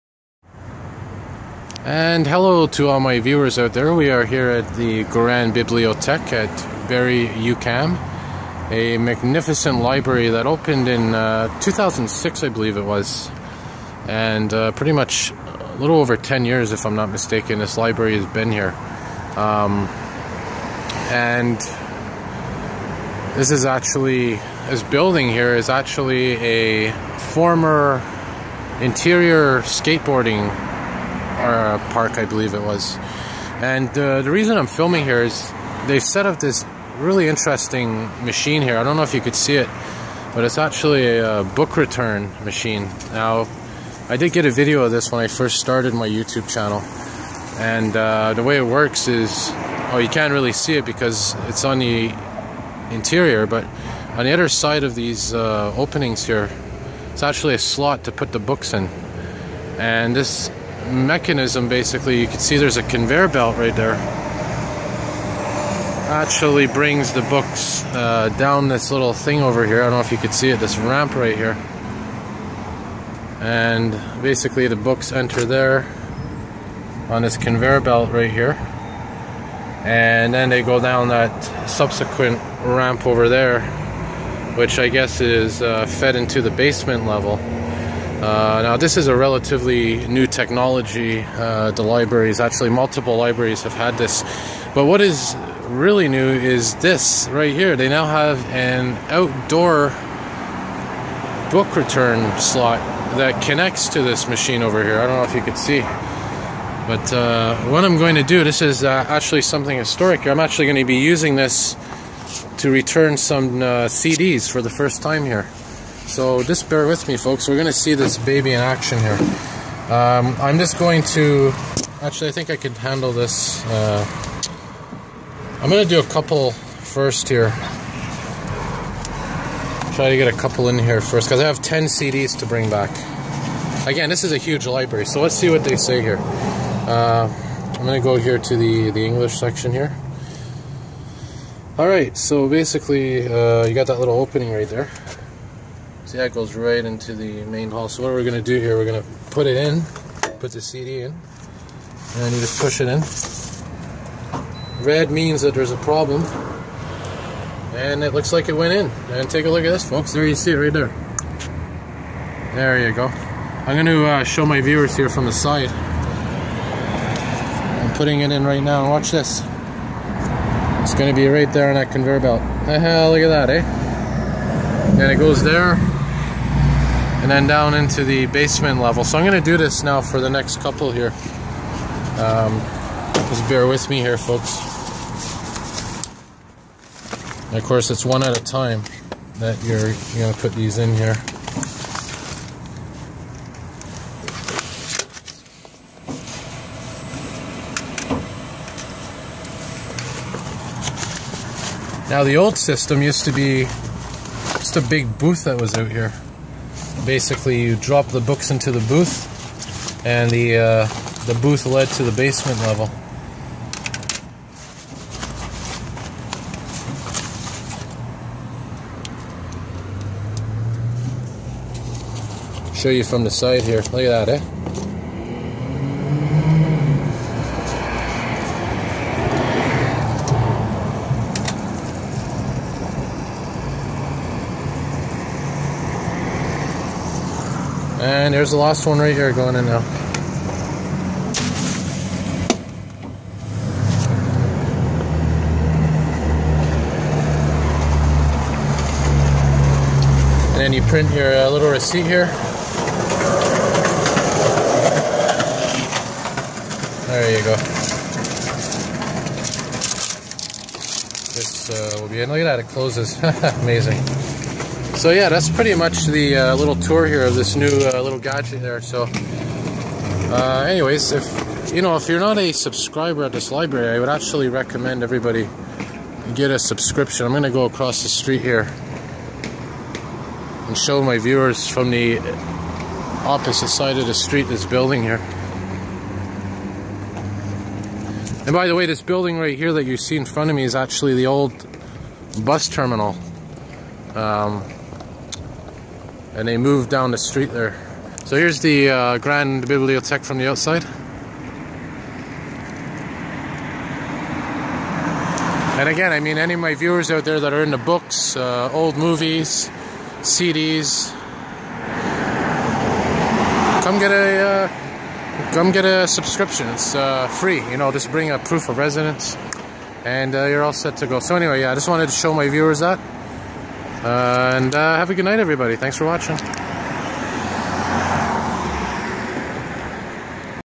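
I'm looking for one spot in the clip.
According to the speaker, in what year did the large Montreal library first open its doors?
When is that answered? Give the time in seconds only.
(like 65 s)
11 s.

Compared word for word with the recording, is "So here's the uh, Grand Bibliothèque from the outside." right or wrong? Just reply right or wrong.
right.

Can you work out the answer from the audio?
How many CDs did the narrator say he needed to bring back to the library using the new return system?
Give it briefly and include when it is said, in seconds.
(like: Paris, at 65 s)
10, at 131 s.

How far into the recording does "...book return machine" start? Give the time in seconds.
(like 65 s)
41 s.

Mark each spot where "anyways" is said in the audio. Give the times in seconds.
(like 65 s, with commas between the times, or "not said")
270 s, 321 s.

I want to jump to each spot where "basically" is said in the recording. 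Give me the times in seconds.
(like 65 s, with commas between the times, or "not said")
61 s, 74 s, 142 s, 207 s.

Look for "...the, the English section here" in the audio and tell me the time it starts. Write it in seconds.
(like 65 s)
138 s.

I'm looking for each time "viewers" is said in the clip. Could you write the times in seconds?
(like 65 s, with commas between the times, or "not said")
3 s, 164 s, 281 s, 306 s, 322 s.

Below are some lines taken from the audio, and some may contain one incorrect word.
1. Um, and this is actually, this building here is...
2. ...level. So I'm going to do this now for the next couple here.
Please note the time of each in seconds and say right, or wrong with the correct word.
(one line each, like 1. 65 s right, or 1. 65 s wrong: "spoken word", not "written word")
1. 19 s right
2. 178 s right.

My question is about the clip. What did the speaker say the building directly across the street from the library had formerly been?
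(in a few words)
Bus terminal.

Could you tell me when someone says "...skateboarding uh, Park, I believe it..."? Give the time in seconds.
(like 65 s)
29 s.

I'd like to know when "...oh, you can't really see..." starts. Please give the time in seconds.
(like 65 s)
49 s.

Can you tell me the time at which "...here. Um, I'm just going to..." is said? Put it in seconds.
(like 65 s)
118 s.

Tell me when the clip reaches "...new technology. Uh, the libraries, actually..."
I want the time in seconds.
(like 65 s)
90 s.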